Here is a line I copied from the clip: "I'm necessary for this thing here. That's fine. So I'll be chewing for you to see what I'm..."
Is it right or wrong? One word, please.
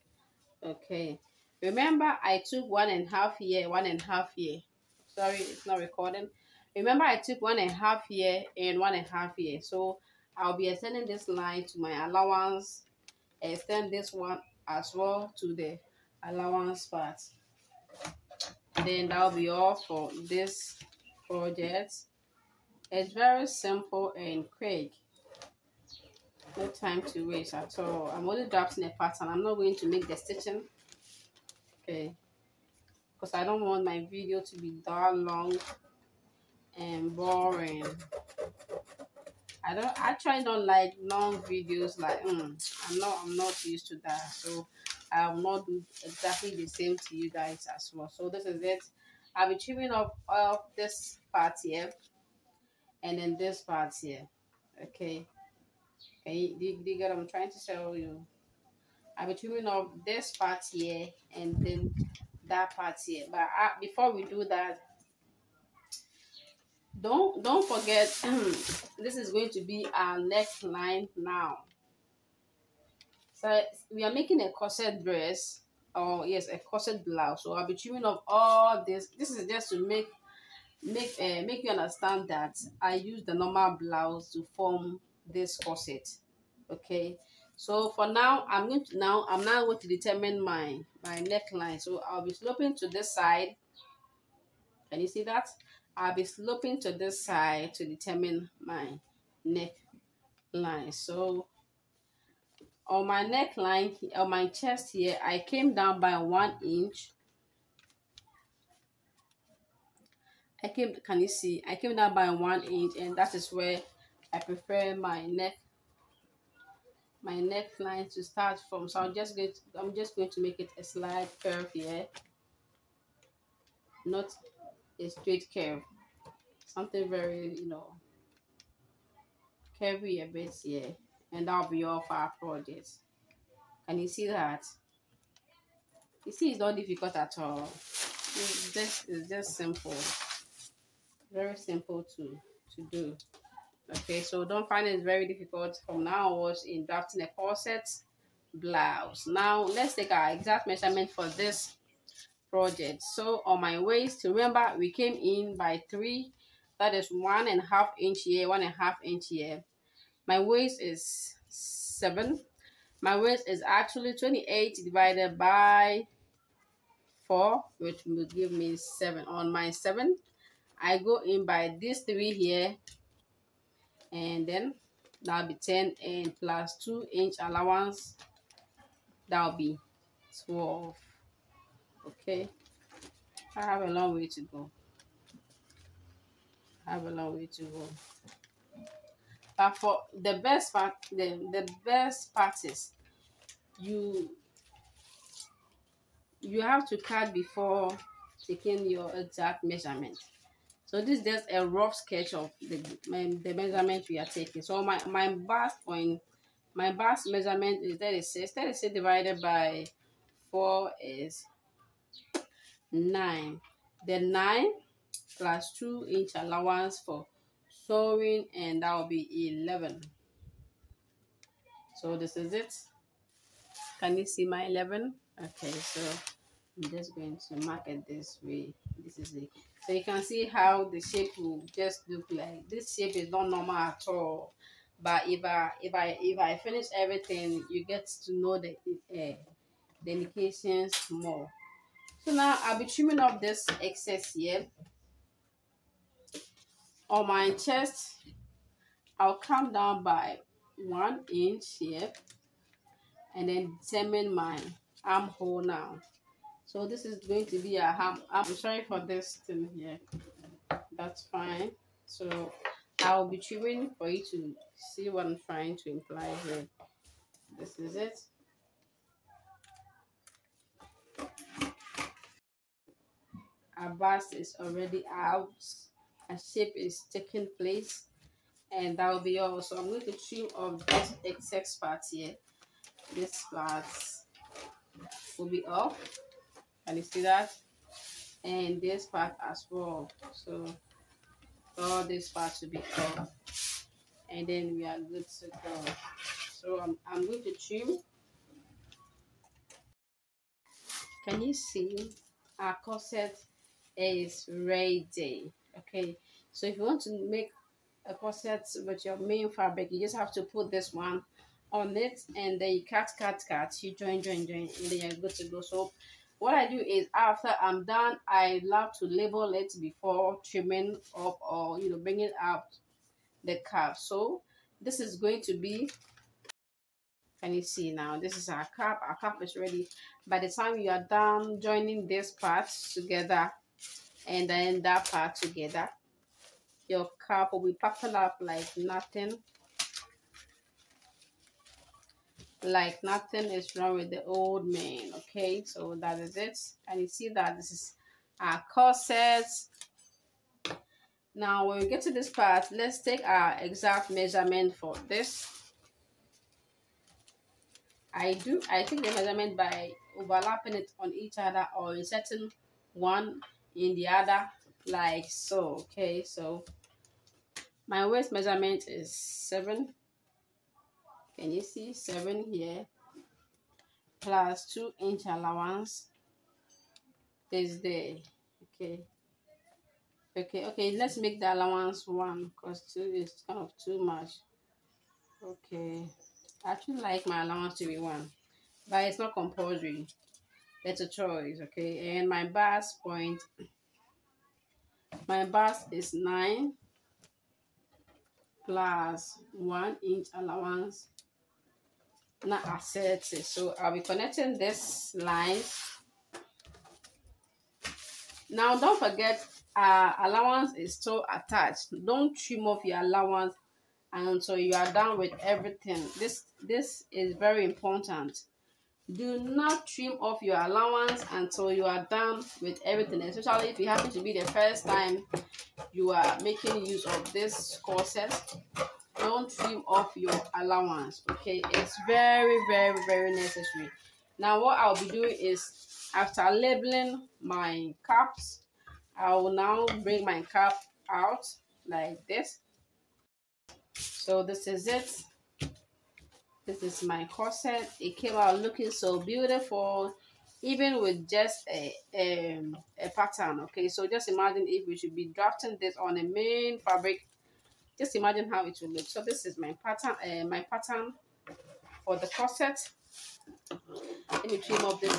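wrong.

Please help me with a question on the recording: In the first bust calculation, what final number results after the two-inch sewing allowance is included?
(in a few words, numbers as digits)
11.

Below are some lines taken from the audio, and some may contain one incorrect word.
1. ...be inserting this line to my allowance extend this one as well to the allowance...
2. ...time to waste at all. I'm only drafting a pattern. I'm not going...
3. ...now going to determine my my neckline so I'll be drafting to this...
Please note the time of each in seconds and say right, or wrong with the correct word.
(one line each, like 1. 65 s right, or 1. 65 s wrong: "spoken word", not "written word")
1. 10 s wrong: "extending", not "inserting"
2. 26 s right
3. 89 s wrong: "sloping", not "drafting".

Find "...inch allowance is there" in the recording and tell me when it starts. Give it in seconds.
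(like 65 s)
374 s.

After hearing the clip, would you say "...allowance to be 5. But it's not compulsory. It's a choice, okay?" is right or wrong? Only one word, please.
wrong.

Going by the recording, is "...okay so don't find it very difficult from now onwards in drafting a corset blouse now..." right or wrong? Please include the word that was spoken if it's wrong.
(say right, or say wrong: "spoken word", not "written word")
right.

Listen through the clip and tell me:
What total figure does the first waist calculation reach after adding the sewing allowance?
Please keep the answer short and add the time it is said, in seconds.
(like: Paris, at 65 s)
12, at 179 s.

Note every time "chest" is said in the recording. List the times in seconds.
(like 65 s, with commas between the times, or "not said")
104 s, 247 s.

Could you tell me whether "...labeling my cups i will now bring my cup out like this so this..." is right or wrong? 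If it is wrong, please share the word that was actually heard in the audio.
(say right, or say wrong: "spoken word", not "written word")
right.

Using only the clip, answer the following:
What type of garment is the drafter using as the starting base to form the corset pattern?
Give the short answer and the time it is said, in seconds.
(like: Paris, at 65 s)
normal blouse, at 83 s.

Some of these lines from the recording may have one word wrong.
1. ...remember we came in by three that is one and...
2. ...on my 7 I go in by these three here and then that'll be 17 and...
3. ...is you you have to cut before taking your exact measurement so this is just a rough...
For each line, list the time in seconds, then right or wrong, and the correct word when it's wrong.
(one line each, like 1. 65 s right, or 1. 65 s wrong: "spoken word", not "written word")
1. 154 s right
2. 169 s wrong: "10", not "17"
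3. 192 s right.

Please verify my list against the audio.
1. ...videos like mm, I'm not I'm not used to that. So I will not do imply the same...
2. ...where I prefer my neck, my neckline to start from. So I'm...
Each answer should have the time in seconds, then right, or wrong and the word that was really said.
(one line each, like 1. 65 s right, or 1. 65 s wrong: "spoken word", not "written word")
1. 41 s wrong: "exactly", not "imply"
2. 113 s right.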